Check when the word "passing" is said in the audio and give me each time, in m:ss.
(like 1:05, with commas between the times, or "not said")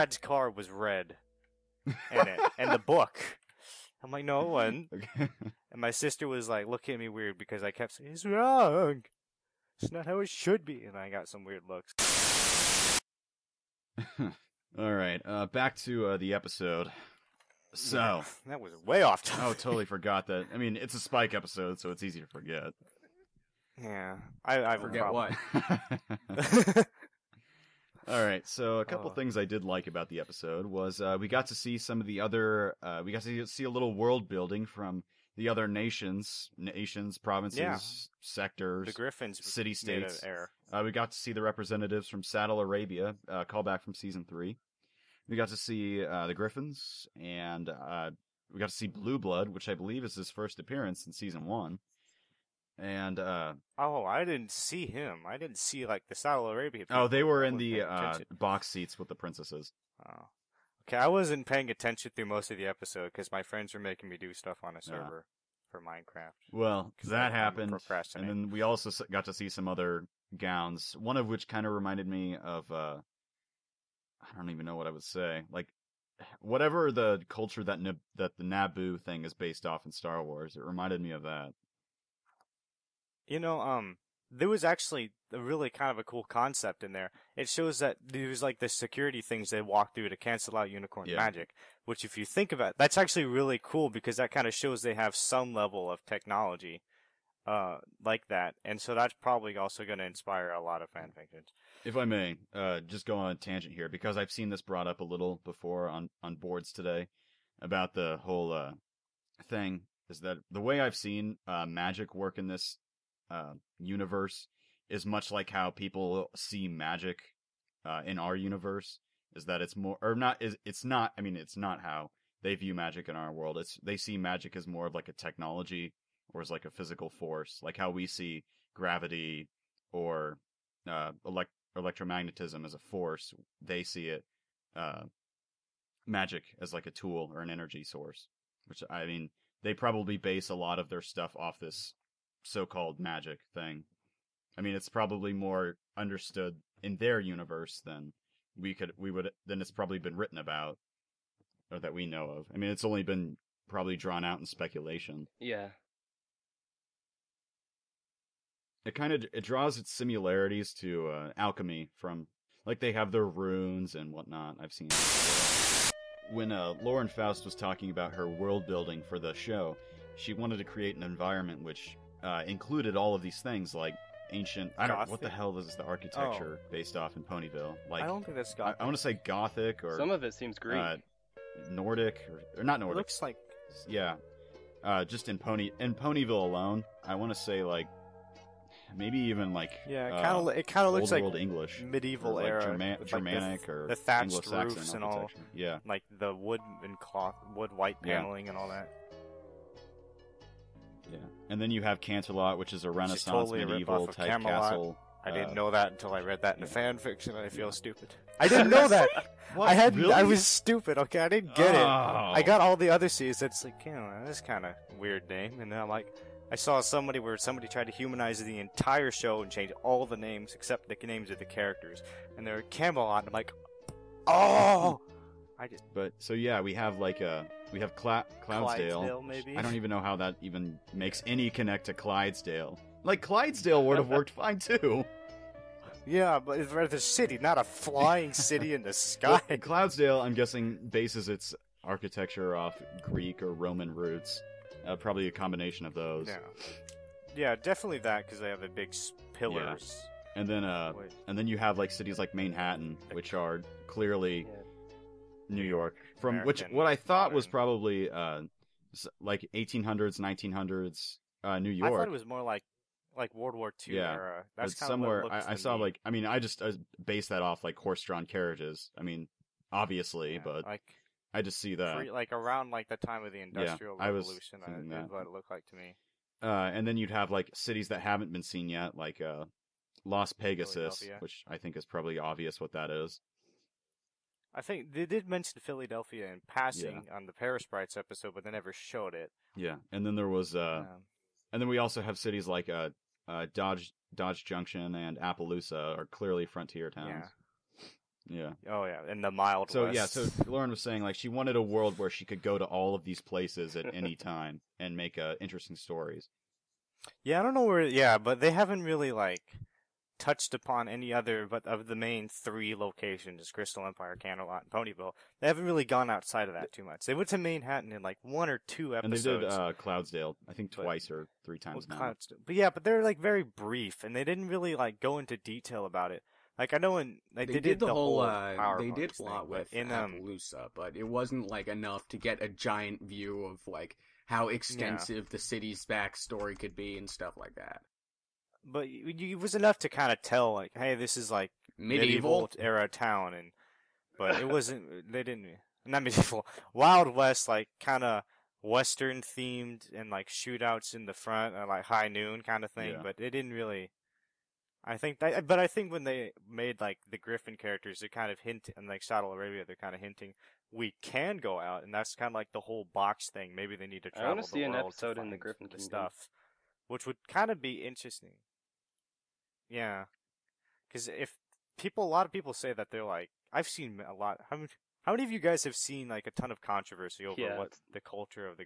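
4:46.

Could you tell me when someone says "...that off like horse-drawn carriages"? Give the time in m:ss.
4:27.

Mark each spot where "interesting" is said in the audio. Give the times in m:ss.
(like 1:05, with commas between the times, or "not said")
5:05, 6:07.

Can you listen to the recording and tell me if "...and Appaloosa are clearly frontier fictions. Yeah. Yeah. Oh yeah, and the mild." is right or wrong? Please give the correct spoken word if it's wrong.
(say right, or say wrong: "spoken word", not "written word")
wrong: "towns", not "fictions".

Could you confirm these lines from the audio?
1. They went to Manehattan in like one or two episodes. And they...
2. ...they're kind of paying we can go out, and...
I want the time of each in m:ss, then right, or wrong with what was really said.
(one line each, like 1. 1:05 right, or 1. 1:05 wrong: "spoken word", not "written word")
1. 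5:17 right
2. 5:59 wrong: "hinting", not "paying".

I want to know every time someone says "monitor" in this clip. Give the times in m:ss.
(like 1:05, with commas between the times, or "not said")
not said.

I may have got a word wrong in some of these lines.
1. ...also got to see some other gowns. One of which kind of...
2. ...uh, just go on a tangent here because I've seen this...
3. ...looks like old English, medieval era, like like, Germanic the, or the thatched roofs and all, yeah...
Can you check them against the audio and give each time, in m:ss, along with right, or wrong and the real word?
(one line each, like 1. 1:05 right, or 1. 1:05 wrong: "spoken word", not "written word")
1. 1:08 right
2. 1:42 right
3. 3:10 right.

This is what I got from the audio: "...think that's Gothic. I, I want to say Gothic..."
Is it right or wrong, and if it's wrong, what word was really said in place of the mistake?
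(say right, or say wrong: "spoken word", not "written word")
right.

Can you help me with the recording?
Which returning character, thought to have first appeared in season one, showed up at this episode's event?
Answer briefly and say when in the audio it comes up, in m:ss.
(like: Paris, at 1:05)
Blue Blood, at 0:48.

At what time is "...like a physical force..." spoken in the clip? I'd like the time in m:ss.
2:06.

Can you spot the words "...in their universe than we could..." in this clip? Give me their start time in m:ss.
2:26.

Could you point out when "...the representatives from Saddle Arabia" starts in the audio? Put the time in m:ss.
0:41.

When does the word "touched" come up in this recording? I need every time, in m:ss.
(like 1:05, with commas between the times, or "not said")
5:10.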